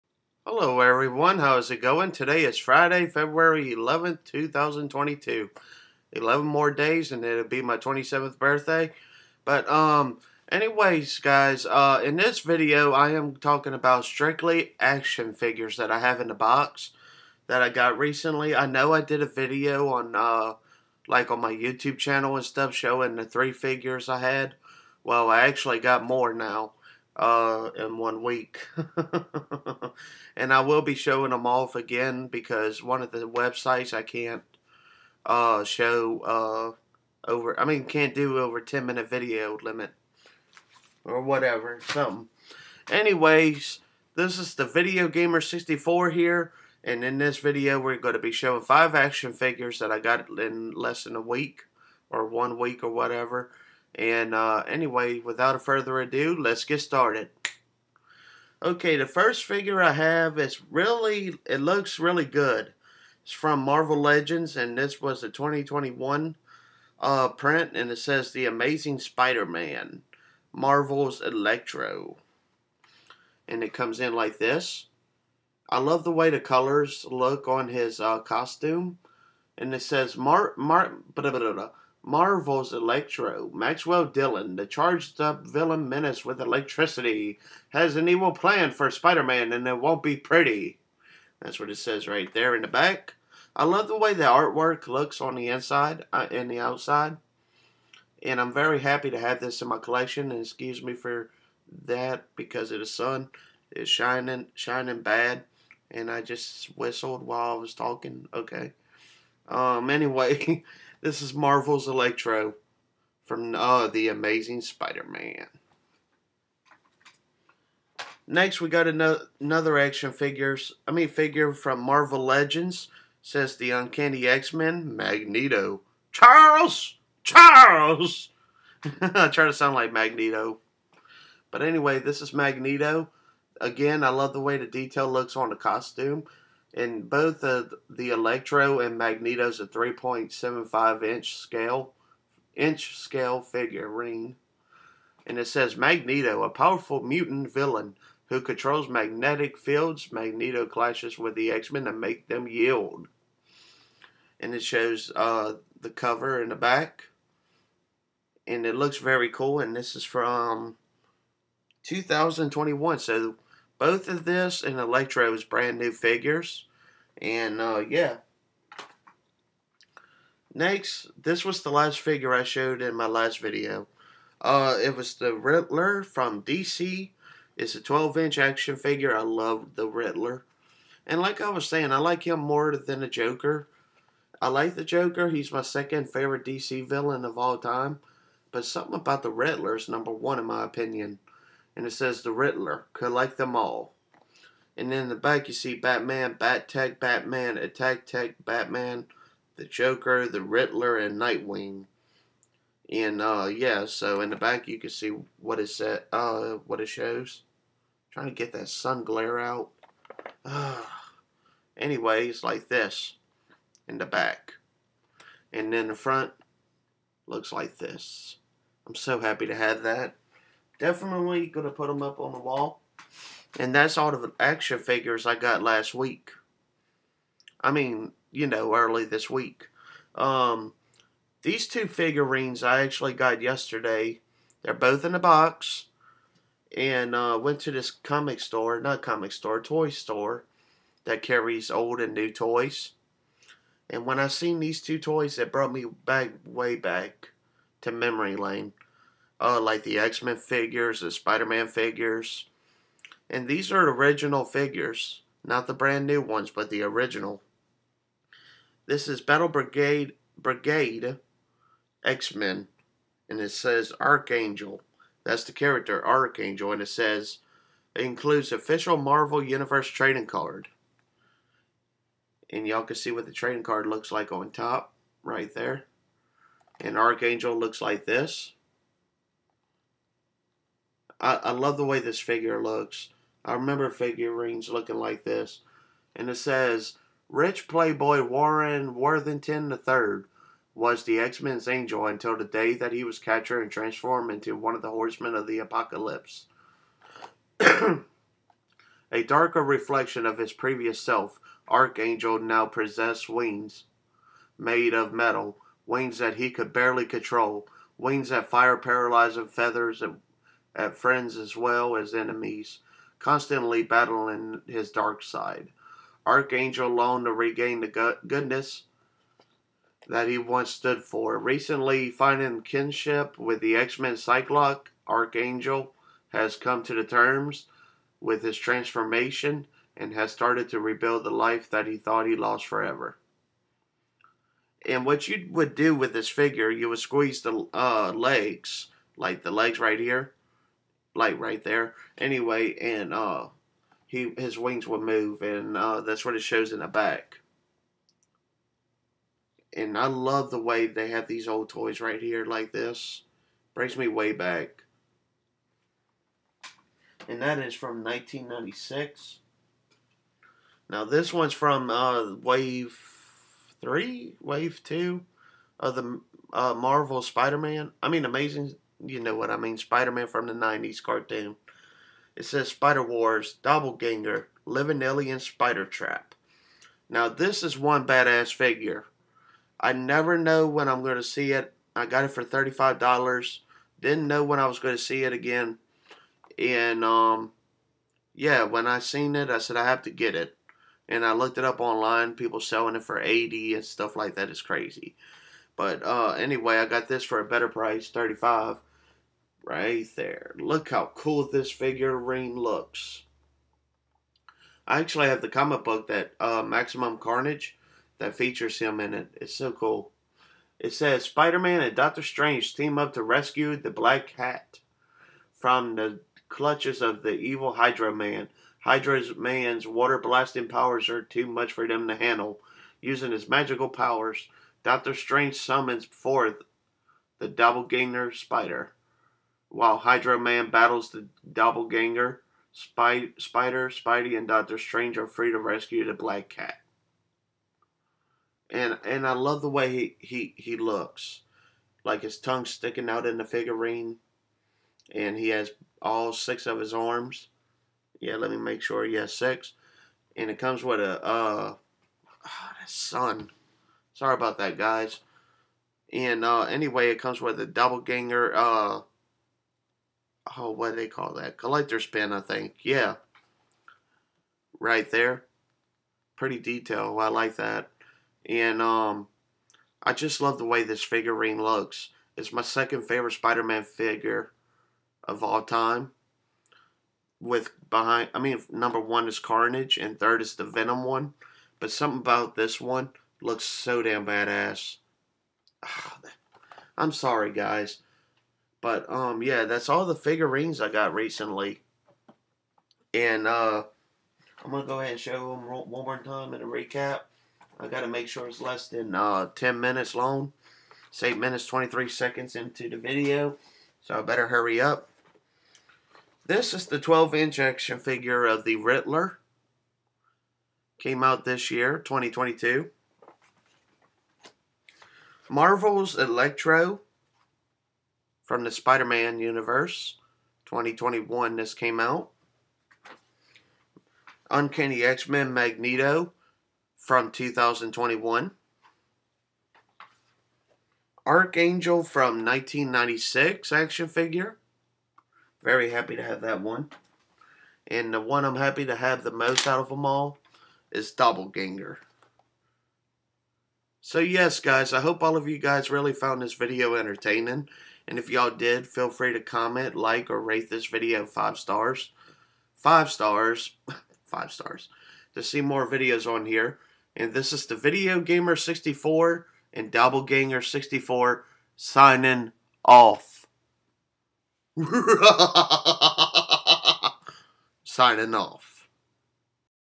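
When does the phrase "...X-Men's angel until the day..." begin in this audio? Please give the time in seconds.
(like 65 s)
291 s.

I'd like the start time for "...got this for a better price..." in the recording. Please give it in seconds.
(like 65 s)
396 s.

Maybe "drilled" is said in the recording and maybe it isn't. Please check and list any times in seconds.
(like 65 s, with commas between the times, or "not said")
not said.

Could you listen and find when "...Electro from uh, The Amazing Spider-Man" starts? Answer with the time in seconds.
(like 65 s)
111 s.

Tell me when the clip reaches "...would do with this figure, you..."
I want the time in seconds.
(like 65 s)
335 s.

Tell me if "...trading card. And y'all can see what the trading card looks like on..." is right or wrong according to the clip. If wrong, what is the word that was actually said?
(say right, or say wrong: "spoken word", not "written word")
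right.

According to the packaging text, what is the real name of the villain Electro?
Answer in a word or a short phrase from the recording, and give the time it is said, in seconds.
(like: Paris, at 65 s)
Maxwell Dillon, at 83 s.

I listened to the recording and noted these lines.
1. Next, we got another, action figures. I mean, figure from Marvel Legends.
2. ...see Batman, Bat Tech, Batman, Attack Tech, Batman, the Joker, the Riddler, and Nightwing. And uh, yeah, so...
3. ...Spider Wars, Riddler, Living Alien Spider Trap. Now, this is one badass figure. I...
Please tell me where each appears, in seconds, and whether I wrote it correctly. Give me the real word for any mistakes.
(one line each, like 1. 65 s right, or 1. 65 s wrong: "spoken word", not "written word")
1. 118 s right
2. 195 s right
3. 372 s wrong: "Doppelganger", not "Riddler".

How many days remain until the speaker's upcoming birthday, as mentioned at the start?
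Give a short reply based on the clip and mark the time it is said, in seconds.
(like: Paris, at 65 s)
11, at 6 s.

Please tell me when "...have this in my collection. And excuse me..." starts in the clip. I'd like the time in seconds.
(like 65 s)
99 s.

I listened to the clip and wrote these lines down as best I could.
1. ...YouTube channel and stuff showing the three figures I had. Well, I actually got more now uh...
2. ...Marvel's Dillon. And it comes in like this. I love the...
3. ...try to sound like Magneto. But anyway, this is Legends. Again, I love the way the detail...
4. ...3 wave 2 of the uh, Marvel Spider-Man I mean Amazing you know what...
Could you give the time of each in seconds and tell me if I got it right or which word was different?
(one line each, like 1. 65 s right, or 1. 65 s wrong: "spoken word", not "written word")
1. 21 s right
2. 70 s wrong: "Electro", not "Dillon"
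3. 129 s wrong: "Magneto", not "Legends"
4. 363 s right.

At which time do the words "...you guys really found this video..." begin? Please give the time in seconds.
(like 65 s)
545 s.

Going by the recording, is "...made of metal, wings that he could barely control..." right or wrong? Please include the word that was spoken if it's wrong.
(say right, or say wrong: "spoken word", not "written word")
right.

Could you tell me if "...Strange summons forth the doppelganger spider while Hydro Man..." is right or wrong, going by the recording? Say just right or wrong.
right.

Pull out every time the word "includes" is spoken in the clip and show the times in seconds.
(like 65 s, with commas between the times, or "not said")
268 s.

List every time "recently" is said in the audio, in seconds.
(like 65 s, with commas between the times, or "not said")
17 s, 321 s, 491 s.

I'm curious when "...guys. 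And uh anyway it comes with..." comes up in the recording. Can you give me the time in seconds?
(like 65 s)
454 s.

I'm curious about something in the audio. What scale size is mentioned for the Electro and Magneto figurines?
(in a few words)
3.75 inch.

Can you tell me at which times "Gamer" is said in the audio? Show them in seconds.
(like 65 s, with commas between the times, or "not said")
45 s, 558 s.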